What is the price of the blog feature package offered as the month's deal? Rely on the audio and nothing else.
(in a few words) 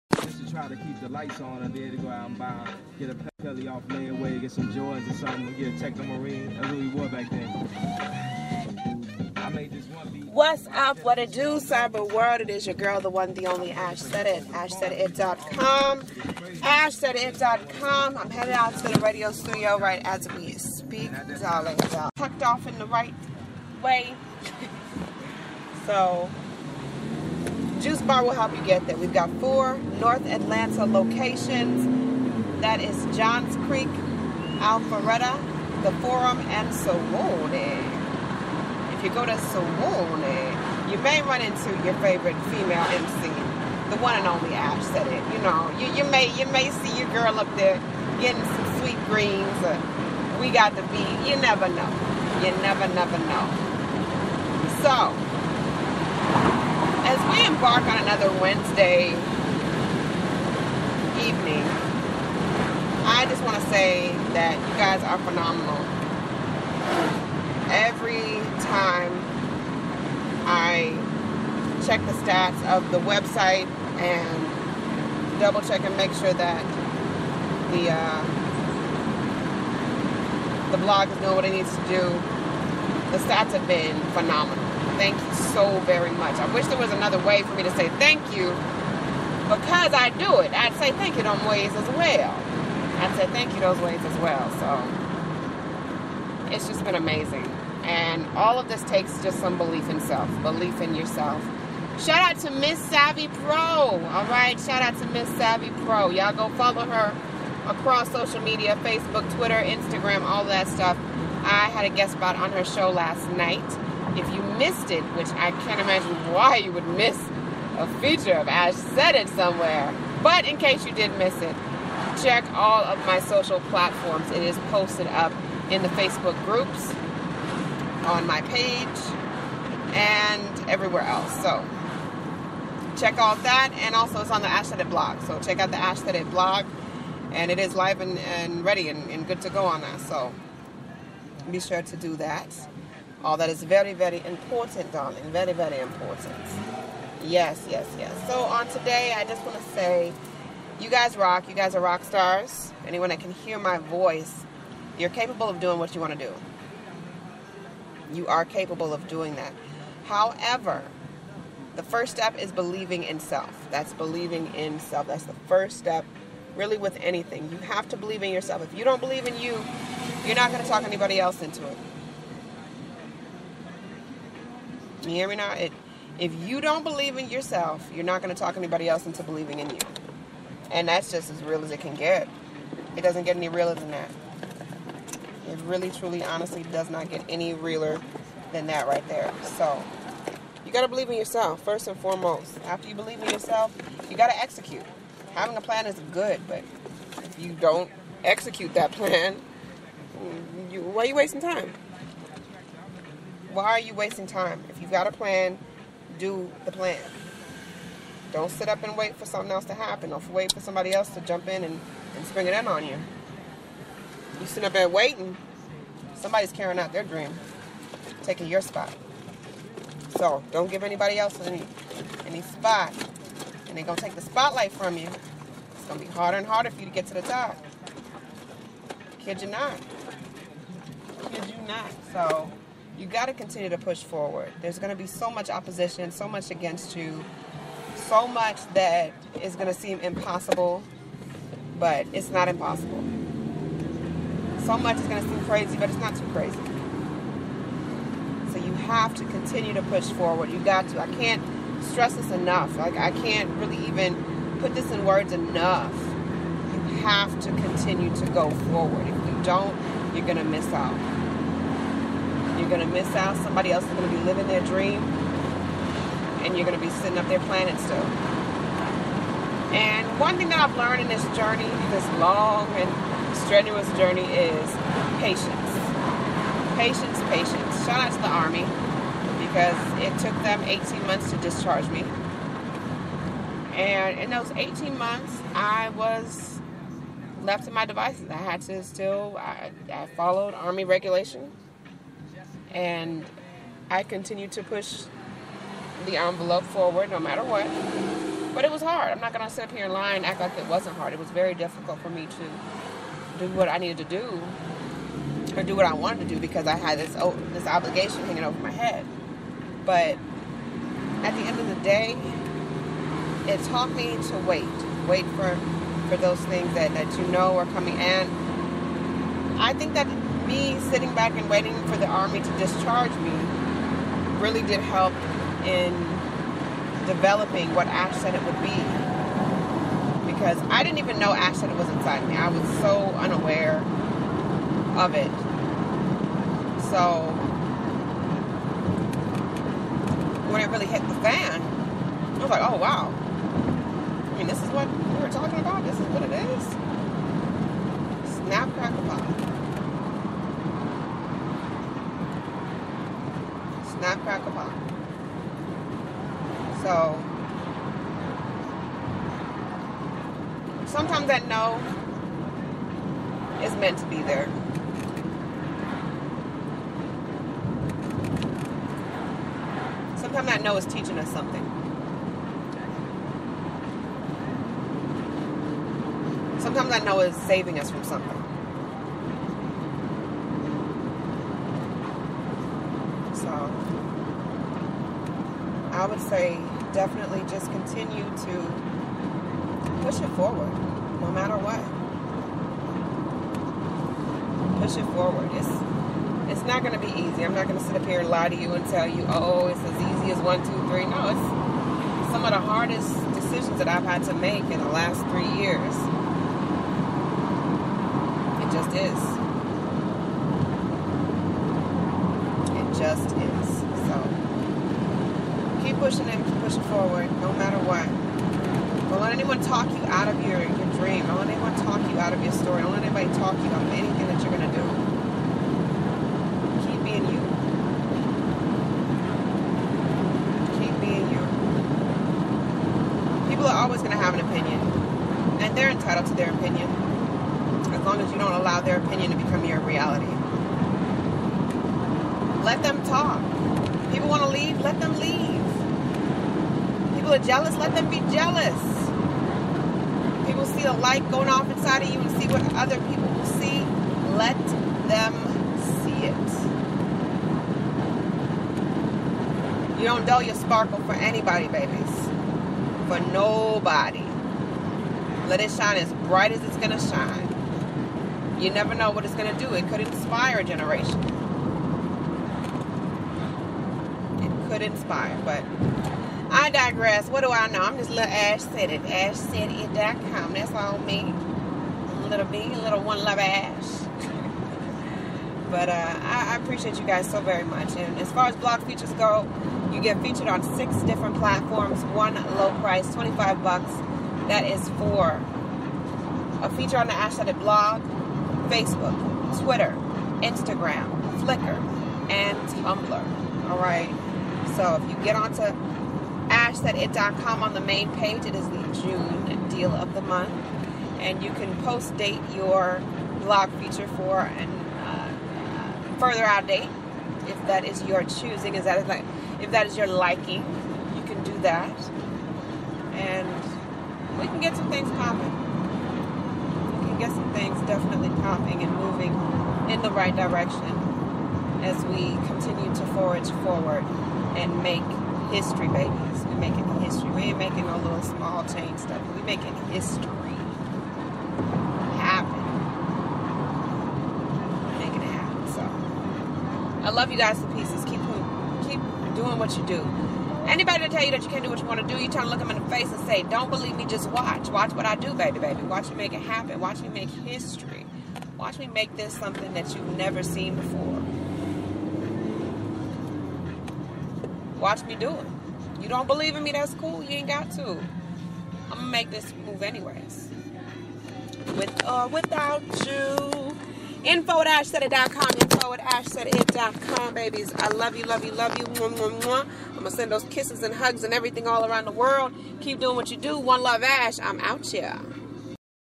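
$25.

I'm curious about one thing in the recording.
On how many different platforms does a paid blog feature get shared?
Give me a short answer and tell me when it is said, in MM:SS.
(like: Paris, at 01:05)
6, at 08:10.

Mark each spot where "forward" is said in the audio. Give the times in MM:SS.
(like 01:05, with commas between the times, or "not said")
03:54, 04:10, 04:18, 04:56, 06:30, 06:35, 06:56, 08:53.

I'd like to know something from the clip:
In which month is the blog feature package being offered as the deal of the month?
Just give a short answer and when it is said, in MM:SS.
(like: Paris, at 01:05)
June, at 08:29.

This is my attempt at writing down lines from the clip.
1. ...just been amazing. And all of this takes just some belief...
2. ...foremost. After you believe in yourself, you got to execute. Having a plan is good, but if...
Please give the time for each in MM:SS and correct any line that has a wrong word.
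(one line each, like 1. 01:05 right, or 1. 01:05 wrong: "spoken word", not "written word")
1. 01:36 right
2. 03:11 right.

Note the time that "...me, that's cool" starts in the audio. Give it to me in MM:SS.
09:26.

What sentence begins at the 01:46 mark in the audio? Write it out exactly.
Y'all go follow her across social media Facebook, Twitter, Instagram, all that stuff.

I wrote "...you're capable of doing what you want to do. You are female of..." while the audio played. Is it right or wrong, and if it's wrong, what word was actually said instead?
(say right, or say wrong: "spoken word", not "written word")
wrong: "capable", not "female".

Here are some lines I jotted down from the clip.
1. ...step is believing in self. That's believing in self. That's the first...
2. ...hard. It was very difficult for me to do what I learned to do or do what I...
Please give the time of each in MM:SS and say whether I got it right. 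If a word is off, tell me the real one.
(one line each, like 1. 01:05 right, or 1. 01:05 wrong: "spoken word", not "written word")
1. 02:42 right
2. 05:00 wrong: "needed", not "learned".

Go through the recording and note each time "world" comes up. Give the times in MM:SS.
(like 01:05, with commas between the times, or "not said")
00:12, 09:42.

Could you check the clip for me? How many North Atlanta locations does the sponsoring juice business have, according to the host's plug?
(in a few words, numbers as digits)
4.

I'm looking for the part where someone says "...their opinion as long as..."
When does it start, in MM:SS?
07:16.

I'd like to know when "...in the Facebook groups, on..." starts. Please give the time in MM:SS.
02:05.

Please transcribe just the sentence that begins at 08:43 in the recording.
And we can get some things popping.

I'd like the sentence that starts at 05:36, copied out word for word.
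So when it really hit the fan, I was like, oh wow.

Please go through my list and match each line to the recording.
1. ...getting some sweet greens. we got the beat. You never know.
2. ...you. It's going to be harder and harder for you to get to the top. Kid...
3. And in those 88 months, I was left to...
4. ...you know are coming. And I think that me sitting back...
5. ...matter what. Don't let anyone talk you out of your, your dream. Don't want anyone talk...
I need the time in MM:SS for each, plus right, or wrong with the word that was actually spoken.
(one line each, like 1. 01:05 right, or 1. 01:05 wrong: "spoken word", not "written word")
1. 00:48 right
2. 03:44 right
3. 04:43 wrong: "18", not "88"
4. 05:17 right
5. 06:57 right.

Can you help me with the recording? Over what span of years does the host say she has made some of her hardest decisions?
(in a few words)
3 years.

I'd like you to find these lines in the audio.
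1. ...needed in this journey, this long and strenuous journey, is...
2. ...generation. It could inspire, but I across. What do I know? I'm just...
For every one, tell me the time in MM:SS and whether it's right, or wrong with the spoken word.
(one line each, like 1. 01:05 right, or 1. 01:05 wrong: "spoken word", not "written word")
1. 04:30 wrong: "learned", not "needed"
2. 07:50 wrong: "digress", not "across".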